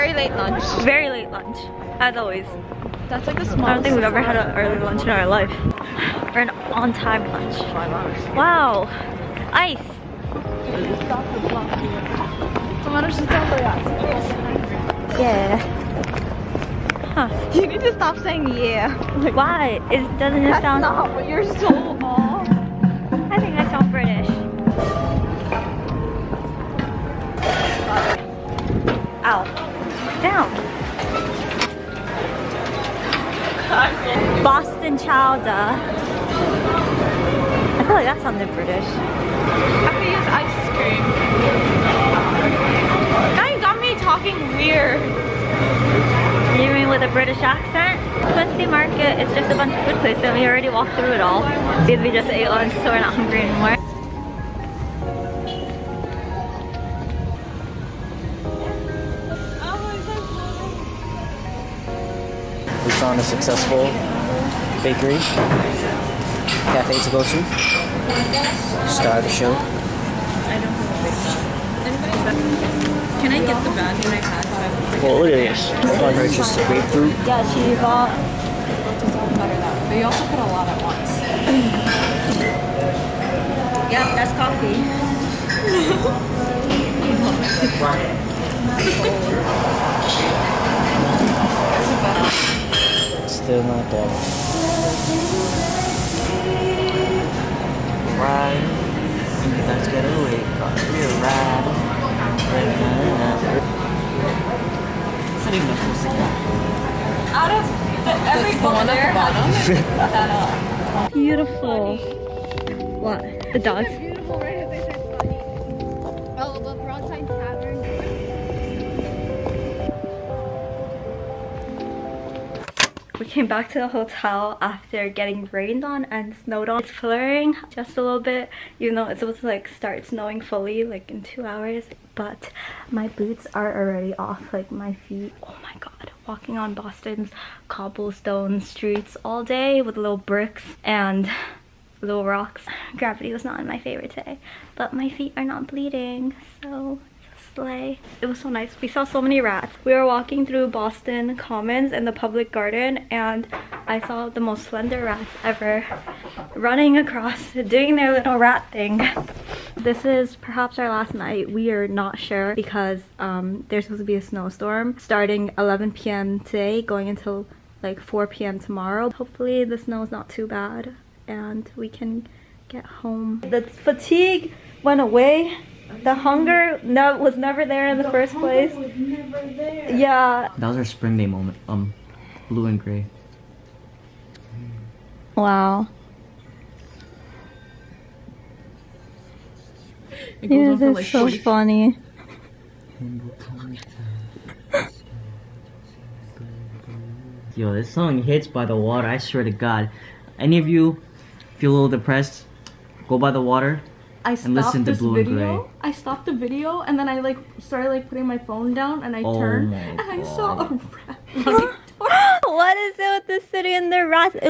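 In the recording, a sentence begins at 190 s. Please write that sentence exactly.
It yeah, that's like so funny.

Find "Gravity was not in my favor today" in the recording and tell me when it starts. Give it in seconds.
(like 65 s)
142 s.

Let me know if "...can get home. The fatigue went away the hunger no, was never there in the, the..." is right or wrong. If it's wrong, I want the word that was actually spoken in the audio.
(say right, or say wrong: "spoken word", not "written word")
right.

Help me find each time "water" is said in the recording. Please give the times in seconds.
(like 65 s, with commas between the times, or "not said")
198 s, 203 s.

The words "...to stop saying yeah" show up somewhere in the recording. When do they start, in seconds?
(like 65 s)
17 s.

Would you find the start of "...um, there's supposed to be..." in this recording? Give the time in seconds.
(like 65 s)
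163 s.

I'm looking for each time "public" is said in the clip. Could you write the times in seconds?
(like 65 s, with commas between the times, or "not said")
152 s.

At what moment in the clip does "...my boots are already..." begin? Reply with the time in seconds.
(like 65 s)
132 s.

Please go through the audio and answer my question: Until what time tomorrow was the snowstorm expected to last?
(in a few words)
4 p.m.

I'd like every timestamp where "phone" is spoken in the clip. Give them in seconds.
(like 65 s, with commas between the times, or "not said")
208 s.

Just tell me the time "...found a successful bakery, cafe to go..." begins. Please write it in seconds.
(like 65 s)
62 s.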